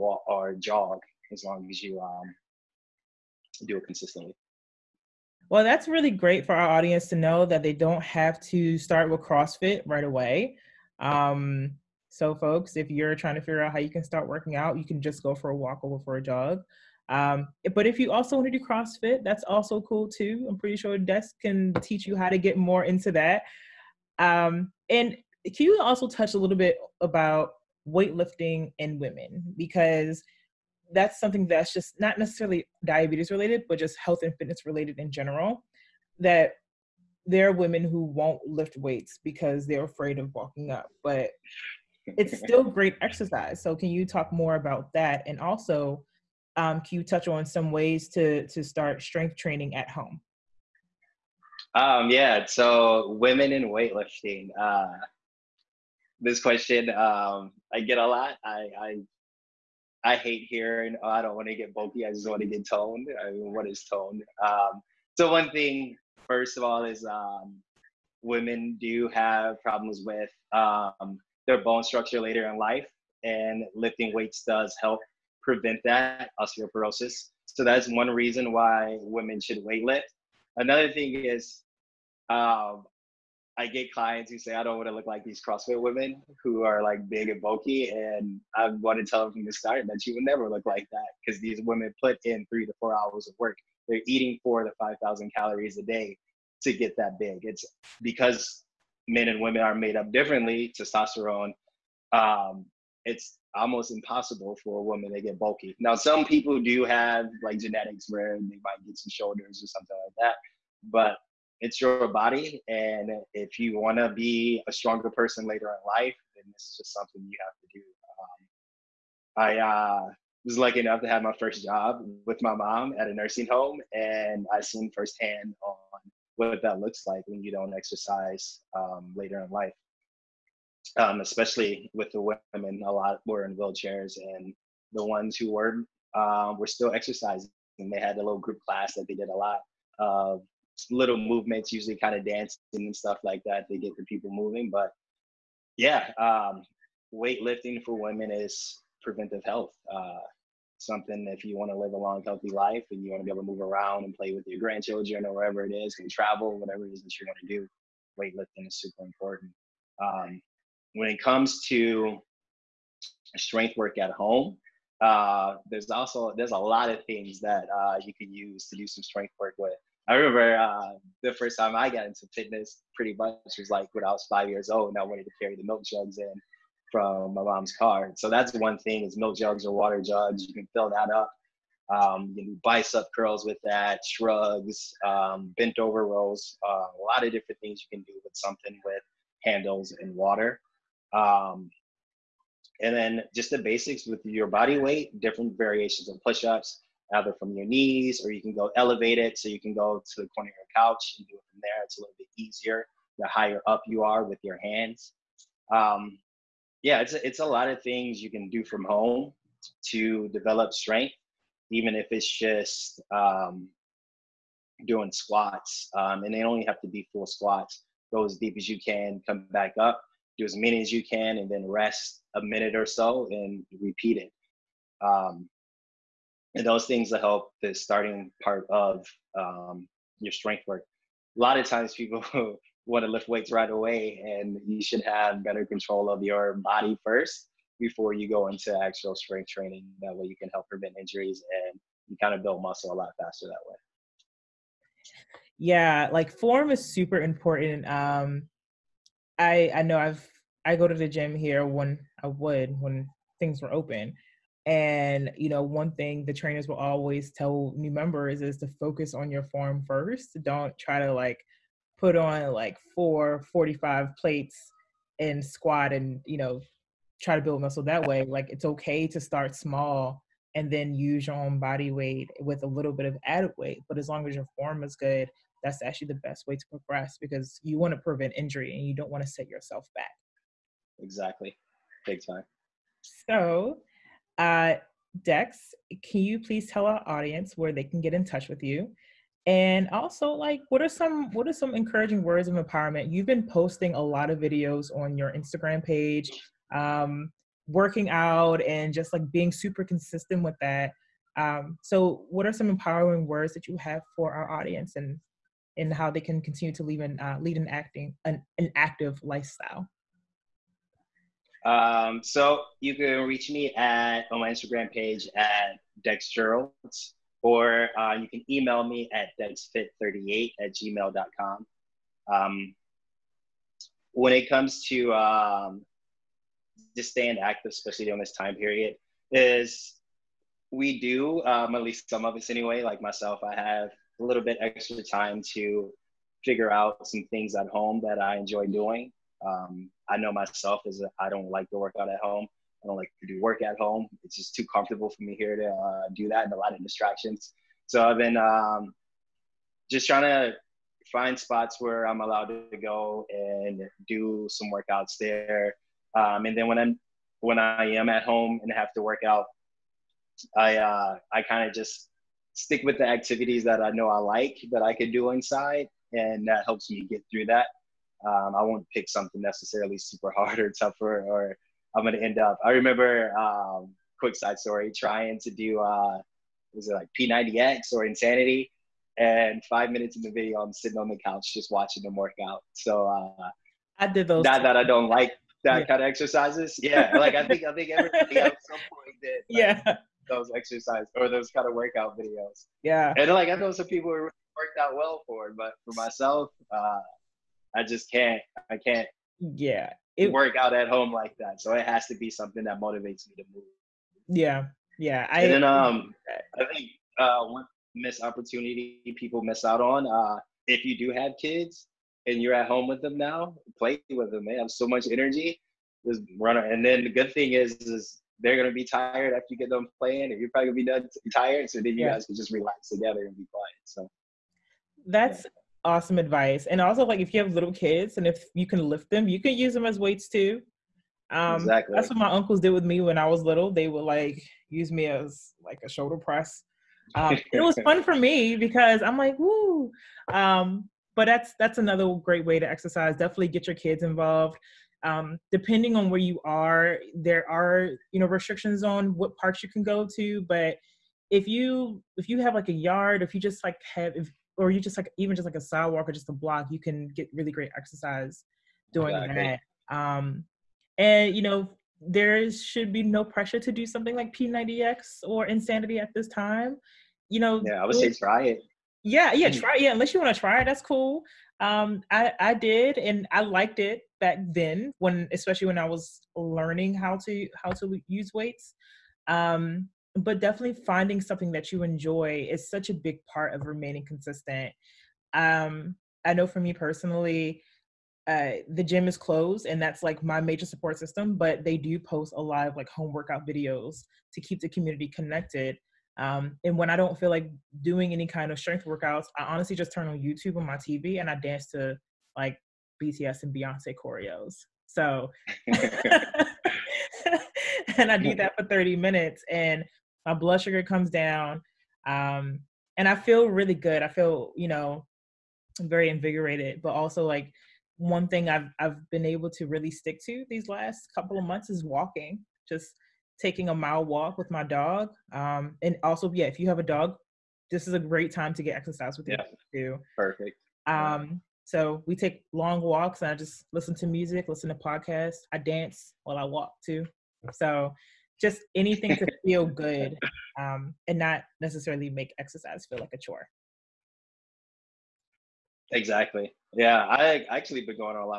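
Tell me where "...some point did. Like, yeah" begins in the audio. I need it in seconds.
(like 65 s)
388 s.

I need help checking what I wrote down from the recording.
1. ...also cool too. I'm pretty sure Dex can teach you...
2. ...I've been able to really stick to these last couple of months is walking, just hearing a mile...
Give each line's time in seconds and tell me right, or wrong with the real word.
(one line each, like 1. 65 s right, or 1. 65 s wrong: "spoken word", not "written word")
1. 19 s right
2. 518 s wrong: "taking", not "hearing".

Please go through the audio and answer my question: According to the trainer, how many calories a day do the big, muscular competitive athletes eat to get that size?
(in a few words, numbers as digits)
4,000 to 5,000.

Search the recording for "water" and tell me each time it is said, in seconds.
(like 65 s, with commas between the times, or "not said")
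179 s, 190 s.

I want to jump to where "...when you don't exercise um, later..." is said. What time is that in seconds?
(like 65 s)
127 s.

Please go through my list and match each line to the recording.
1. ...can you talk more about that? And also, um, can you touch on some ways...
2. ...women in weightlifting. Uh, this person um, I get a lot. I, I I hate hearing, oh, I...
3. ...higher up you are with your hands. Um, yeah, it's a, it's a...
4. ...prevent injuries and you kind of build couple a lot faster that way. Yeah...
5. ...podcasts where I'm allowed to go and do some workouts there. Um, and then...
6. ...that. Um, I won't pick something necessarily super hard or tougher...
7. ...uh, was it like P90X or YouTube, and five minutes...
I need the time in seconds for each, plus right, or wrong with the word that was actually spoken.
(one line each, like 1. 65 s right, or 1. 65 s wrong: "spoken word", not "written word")
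1. 43 s right
2. 53 s wrong: "question", not "person"
3. 203 s right
4. 240 s wrong: "muscle", not "couple"
5. 351 s wrong: "spots", not "podcasts"
6. 367 s right
7. 375 s wrong: "Insanity", not "YouTube".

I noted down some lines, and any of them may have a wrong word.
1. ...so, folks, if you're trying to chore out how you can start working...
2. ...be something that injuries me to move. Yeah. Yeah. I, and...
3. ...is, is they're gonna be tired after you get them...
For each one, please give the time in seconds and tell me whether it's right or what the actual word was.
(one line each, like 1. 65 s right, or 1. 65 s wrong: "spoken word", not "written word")
1. 12 s wrong: "figure", not "chore"
2. 402 s wrong: "motivates", not "injuries"
3. 417 s right.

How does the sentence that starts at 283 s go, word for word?
So uh, Dex, can you please tell our audience where they can get in touch with you?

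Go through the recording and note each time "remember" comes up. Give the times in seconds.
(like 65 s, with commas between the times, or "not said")
170 s, 372 s.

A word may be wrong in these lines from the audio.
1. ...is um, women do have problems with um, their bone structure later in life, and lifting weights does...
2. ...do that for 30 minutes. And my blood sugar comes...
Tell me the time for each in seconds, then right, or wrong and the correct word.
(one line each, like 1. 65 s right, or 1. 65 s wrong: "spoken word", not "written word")
1. 66 s right
2. 508 s right.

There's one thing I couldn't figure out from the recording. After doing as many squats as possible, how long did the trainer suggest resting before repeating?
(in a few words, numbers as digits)
a minute.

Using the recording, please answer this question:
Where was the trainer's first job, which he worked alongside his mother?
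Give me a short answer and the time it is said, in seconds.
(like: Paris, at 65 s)
a nursing home, at 123 s.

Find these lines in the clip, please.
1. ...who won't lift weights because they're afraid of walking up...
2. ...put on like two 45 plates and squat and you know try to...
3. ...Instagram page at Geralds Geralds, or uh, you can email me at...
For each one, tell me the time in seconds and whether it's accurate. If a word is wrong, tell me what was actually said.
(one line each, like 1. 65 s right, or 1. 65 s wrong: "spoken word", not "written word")
1. 37 s right
2. 261 s wrong: "four", not "two"
3. 314 s wrong: "Dex", not "Geralds".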